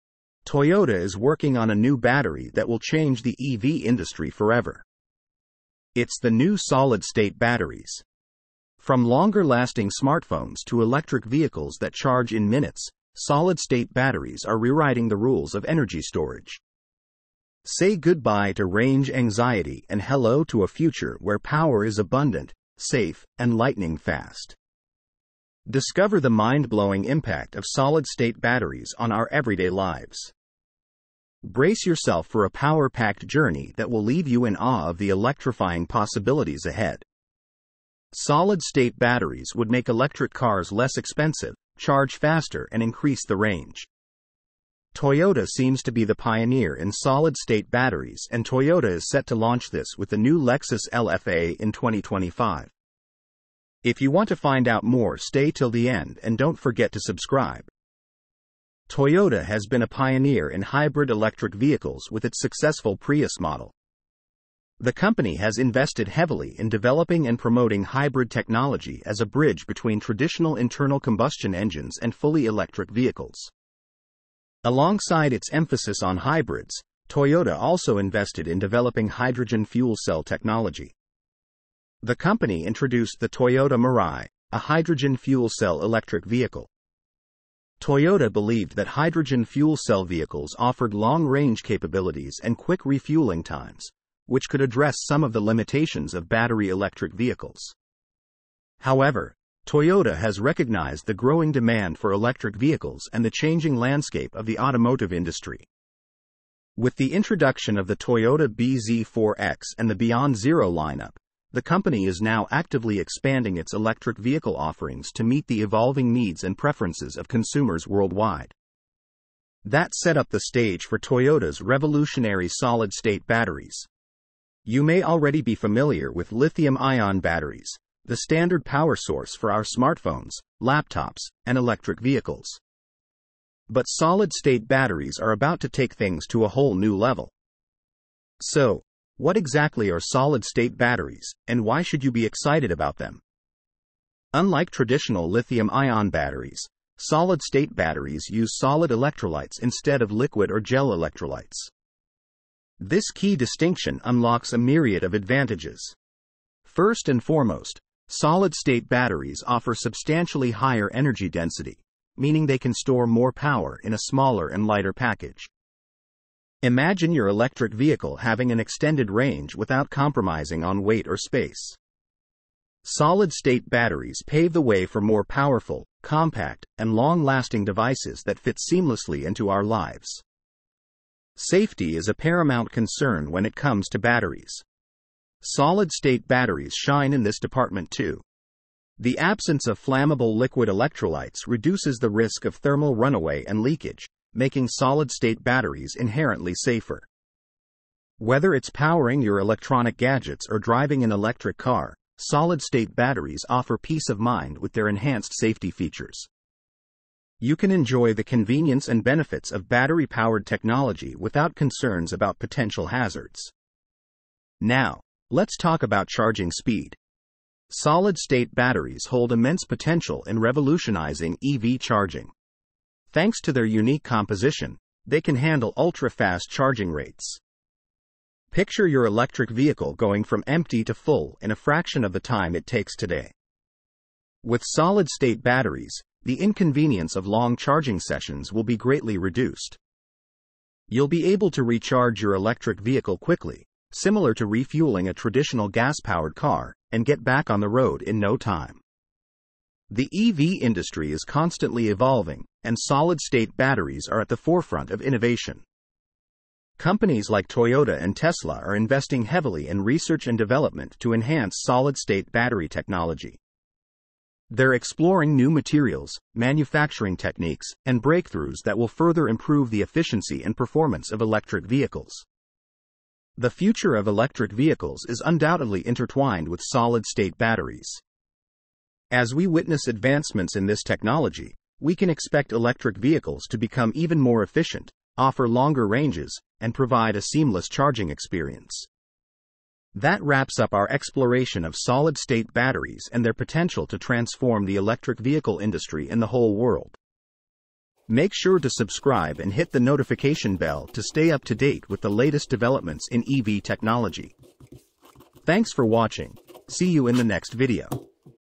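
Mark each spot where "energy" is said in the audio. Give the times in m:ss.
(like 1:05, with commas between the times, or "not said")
0:15, 2:40.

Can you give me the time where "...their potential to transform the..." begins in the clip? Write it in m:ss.
4:53.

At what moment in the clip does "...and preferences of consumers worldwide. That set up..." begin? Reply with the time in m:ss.
1:56.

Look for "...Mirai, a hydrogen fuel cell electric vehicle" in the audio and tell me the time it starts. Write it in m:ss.
1:23.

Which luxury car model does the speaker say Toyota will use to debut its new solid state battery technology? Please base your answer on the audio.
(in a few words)
Lexus LFA.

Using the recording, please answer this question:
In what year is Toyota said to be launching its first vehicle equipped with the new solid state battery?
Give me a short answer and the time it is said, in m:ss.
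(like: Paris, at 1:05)
2025, at 0:51.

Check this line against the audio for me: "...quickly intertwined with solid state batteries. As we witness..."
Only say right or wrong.
wrong.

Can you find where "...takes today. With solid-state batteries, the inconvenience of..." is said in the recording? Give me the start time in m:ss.
3:52.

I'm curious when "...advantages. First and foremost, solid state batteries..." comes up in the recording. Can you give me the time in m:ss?
2:35.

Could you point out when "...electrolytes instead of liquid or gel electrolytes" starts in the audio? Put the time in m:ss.
2:28.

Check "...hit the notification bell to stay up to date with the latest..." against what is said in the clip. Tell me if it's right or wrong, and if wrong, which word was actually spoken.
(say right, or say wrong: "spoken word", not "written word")
right.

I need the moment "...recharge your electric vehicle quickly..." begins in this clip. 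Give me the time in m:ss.
4:01.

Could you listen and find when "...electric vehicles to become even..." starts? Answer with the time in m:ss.
4:42.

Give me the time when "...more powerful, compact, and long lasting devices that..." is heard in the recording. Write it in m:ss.
2:55.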